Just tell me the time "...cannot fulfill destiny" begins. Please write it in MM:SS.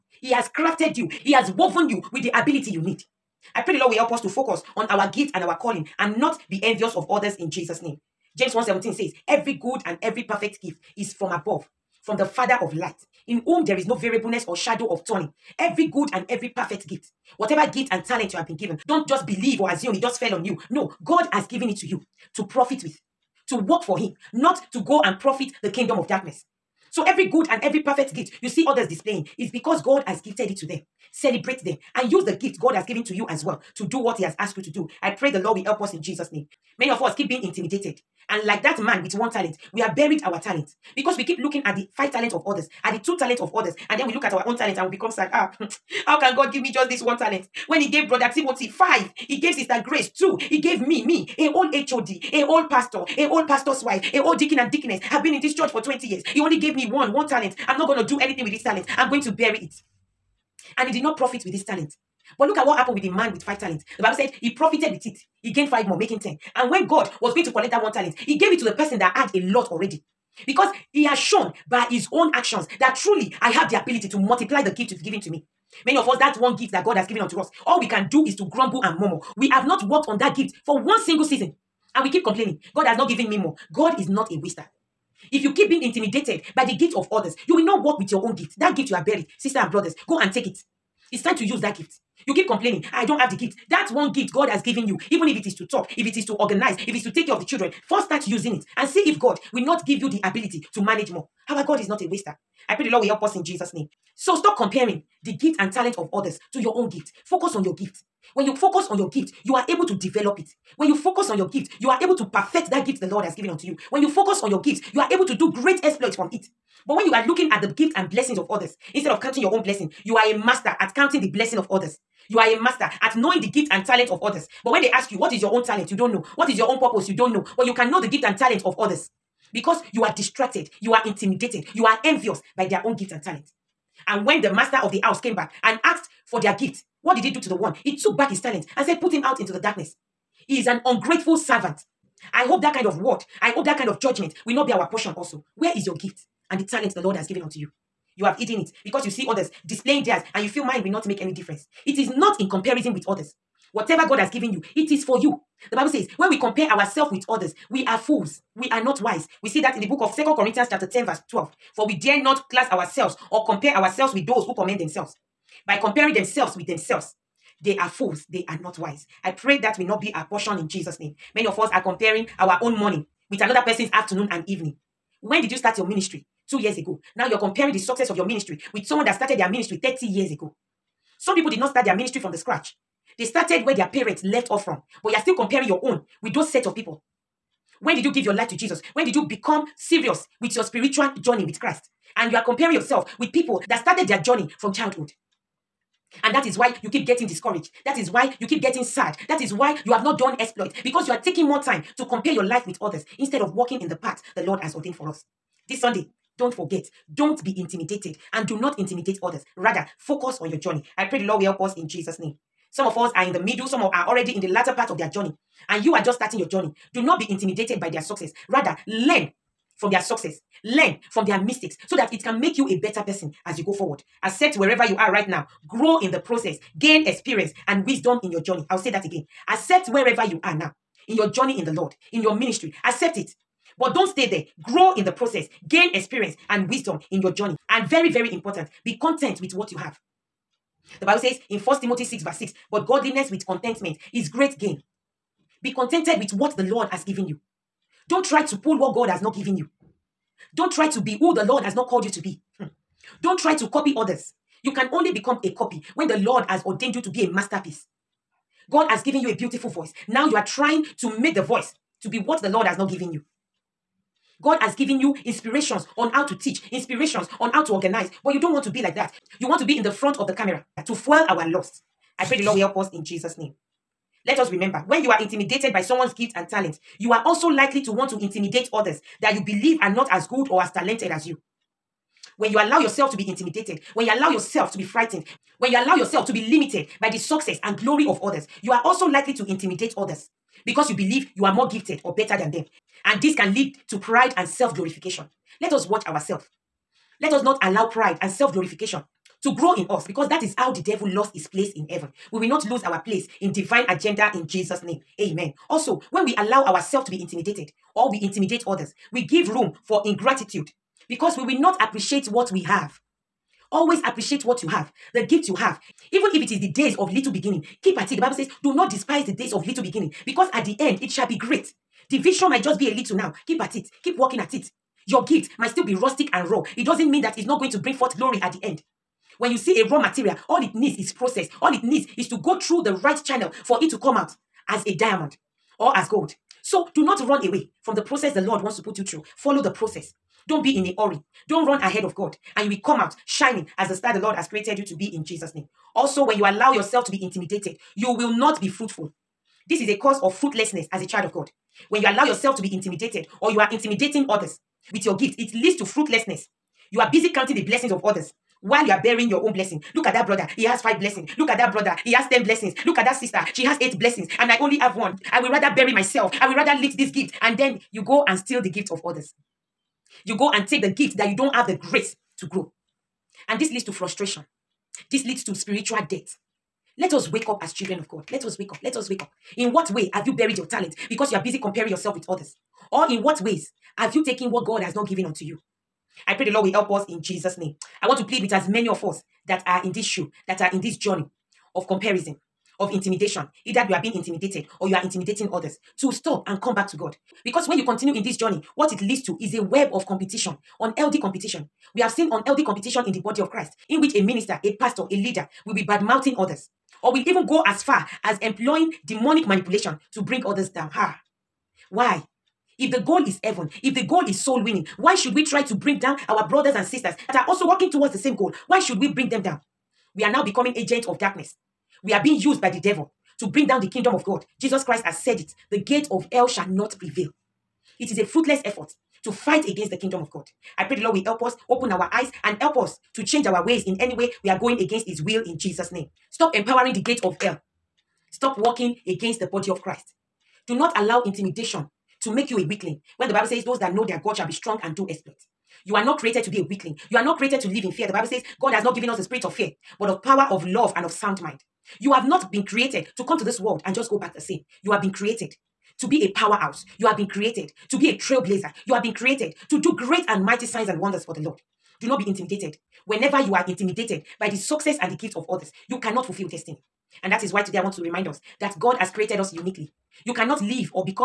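07:45.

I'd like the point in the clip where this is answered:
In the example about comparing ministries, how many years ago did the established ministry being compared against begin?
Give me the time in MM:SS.
02:59.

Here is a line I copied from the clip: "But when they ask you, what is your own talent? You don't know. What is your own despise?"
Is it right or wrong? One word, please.
wrong.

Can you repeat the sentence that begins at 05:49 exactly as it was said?
This is a cause of fruitlessness as a child of God.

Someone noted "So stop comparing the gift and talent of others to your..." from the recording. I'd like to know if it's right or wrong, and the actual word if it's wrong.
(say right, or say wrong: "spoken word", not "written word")
right.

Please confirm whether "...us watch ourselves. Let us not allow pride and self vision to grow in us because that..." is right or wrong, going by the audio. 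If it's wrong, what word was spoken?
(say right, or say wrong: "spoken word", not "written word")
wrong: "glorification", not "vision".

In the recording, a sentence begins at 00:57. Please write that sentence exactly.
I'm not going to do anything with this talent.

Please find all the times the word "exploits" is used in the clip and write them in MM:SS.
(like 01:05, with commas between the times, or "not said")
01:55, 03:20, 07:25.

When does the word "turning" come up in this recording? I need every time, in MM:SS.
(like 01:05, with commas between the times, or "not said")
00:15.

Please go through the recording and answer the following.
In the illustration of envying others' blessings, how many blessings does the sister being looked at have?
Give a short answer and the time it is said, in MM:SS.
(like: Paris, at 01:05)
8, at 06:03.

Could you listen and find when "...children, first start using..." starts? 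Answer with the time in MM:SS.
01:37.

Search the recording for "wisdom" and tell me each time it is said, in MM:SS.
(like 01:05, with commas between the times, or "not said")
03:47, 03:56.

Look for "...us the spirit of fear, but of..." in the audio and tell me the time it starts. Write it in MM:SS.
07:29.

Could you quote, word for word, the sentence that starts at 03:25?
This Sunday, don't forget don't be intimidated and do not intimidate others.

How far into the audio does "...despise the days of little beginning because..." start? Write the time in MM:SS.
05:18.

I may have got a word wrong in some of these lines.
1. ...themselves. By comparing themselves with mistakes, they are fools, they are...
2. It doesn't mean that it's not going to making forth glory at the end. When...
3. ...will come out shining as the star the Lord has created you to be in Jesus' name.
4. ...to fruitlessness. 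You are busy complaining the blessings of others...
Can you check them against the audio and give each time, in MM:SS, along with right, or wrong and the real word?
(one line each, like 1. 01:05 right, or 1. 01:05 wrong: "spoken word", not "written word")
1. 02:44 wrong: "themselves", not "mistakes"
2. 05:26 wrong: "bring", not "making"
3. 05:42 right
4. 05:55 wrong: "counting", not "complaining".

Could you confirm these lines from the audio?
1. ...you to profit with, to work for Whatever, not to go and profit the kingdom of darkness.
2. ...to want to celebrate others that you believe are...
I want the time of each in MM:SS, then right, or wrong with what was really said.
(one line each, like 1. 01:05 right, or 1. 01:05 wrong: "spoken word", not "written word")
1. 00:21 wrong: "Him", not "Whatever"
2. 04:37 wrong: "intimidate", not "celebrate".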